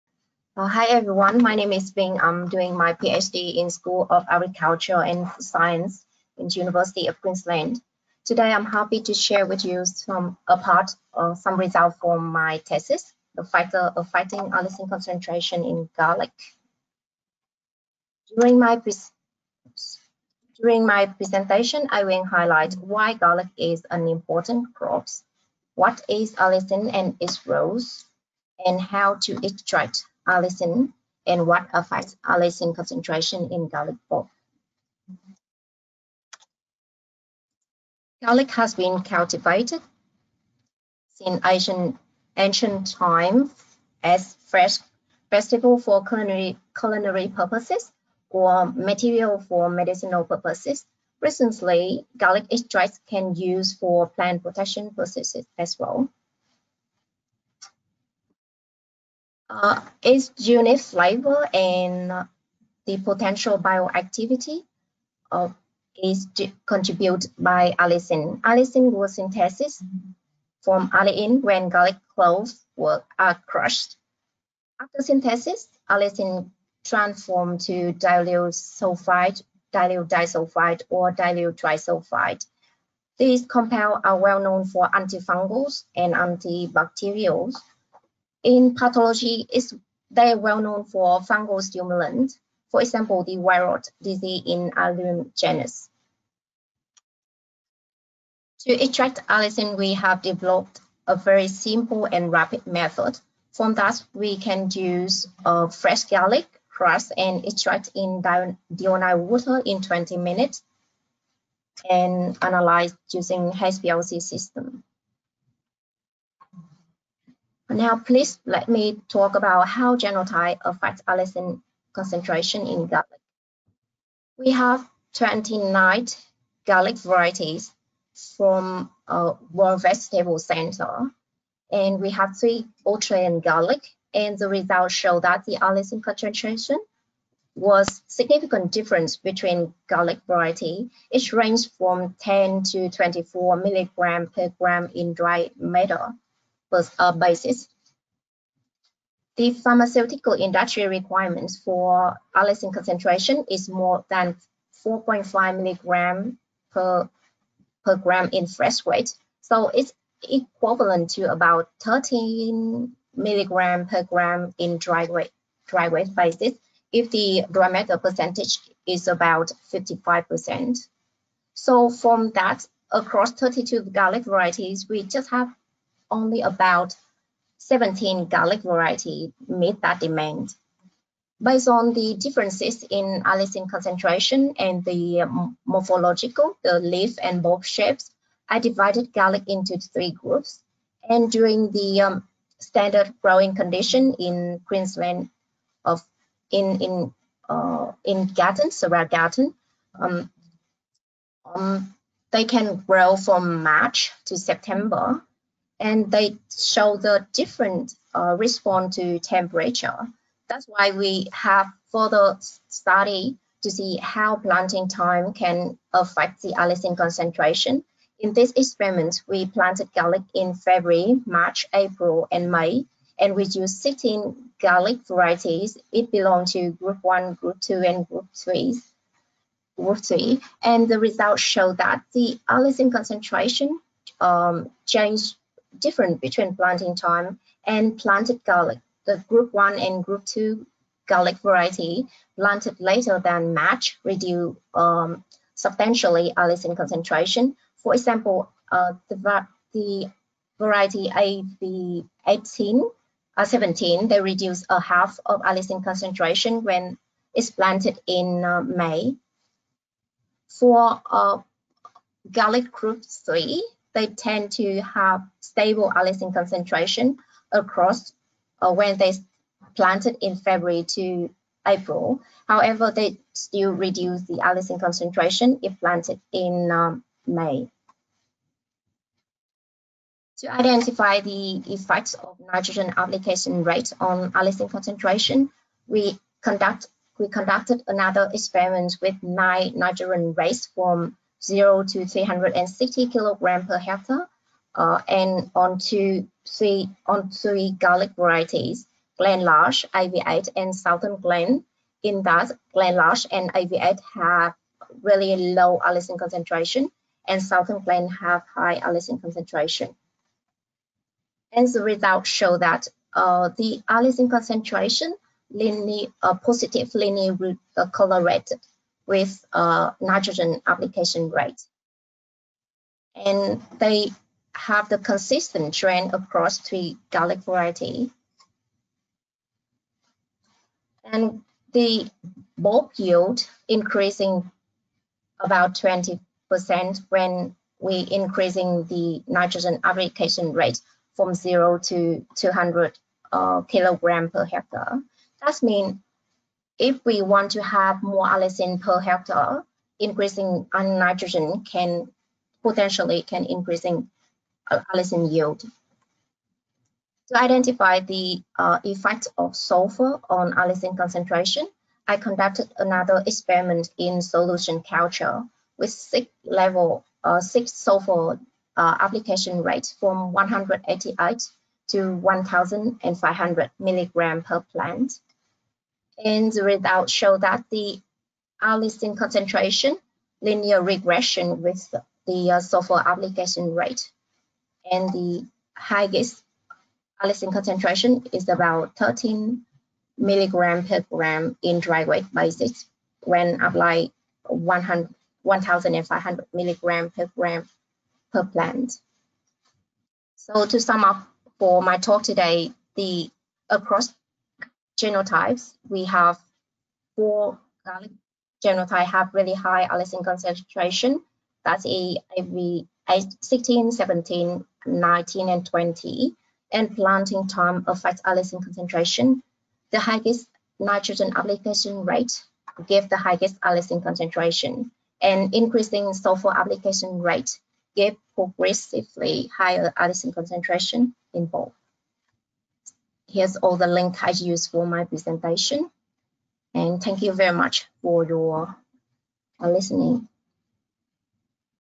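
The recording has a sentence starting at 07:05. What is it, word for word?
And increasing sulfur application rate give progressively higher allicin concentration in both here's all the link I use for my presentation.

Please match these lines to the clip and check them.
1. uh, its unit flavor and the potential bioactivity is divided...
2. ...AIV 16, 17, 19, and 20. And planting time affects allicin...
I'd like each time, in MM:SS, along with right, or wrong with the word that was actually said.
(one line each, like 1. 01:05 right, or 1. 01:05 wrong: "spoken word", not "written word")
1. 00:59 wrong: "contributed", not "divided"
2. 06:51 right.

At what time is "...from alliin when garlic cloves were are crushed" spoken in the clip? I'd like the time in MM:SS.
01:10.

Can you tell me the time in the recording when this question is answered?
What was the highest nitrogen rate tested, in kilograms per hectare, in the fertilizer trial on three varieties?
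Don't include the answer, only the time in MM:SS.
04:52.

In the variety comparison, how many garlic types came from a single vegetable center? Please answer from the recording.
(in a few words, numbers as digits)
29.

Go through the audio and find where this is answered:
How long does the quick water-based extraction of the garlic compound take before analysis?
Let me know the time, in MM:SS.
01:49.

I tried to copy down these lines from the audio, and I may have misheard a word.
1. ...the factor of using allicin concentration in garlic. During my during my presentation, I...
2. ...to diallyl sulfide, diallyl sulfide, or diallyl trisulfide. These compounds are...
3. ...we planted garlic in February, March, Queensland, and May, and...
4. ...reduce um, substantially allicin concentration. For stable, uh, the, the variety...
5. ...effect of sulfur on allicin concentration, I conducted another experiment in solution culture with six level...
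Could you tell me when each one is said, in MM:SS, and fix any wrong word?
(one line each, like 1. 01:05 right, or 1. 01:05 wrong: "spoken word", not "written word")
1. 00:13 wrong: "fighting", not "using"
2. 01:17 wrong: "disulfide", not "sulfide"
3. 03:39 wrong: "April", not "Queensland"
4. 04:04 wrong: "example", not "stable"
5. 05:58 right.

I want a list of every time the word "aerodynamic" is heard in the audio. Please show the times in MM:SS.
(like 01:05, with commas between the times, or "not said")
not said.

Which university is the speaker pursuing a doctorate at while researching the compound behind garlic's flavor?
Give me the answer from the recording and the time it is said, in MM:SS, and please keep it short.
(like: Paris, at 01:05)
University of Queensland, at 00:06.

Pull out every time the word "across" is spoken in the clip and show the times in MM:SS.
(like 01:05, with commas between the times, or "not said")
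02:52, 04:27, 05:26, 06:43.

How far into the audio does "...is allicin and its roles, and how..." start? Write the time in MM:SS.
00:26.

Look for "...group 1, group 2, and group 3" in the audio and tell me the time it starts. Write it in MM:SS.
03:46.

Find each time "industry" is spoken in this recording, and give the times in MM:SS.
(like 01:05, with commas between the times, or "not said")
02:30.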